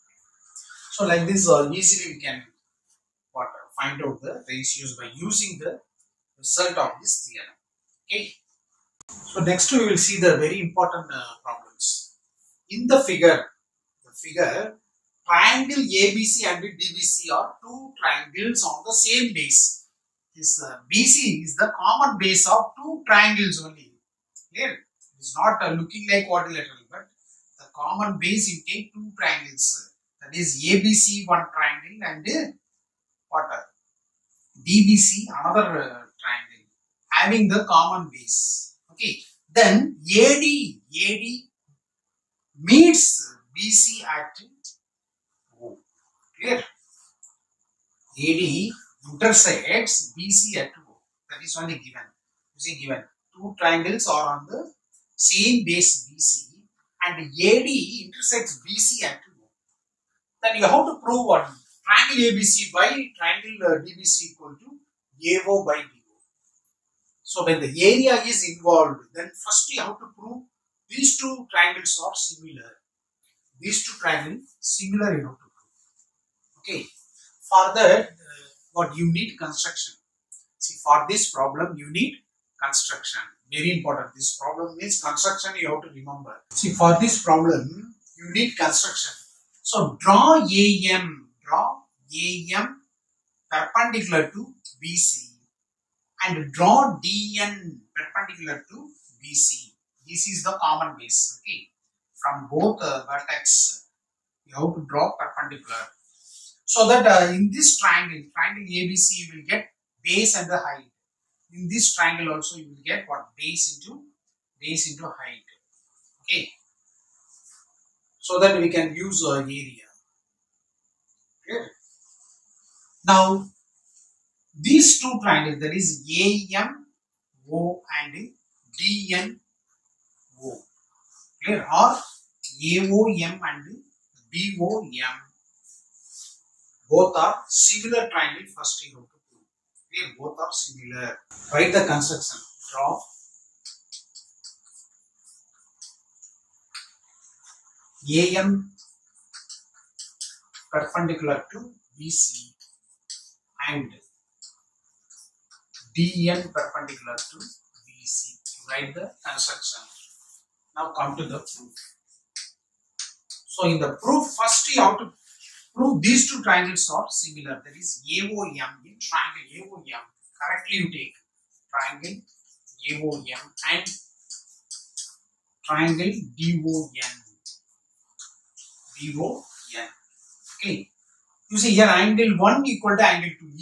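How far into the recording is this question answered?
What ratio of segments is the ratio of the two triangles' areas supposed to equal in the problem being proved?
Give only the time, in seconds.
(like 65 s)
65 s.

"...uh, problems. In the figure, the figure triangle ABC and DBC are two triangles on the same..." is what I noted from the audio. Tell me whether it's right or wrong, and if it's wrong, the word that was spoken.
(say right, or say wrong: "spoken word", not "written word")
right.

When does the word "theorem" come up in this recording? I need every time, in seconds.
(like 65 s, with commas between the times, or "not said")
7 s.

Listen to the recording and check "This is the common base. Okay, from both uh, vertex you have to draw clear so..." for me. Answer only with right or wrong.
wrong.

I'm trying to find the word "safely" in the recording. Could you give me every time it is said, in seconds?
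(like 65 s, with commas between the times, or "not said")
not said.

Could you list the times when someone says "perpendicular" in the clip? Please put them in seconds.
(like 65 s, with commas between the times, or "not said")
93 s, 97 s, 105 s, 150 s, 156 s.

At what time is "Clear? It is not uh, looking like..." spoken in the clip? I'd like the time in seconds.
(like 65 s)
24 s.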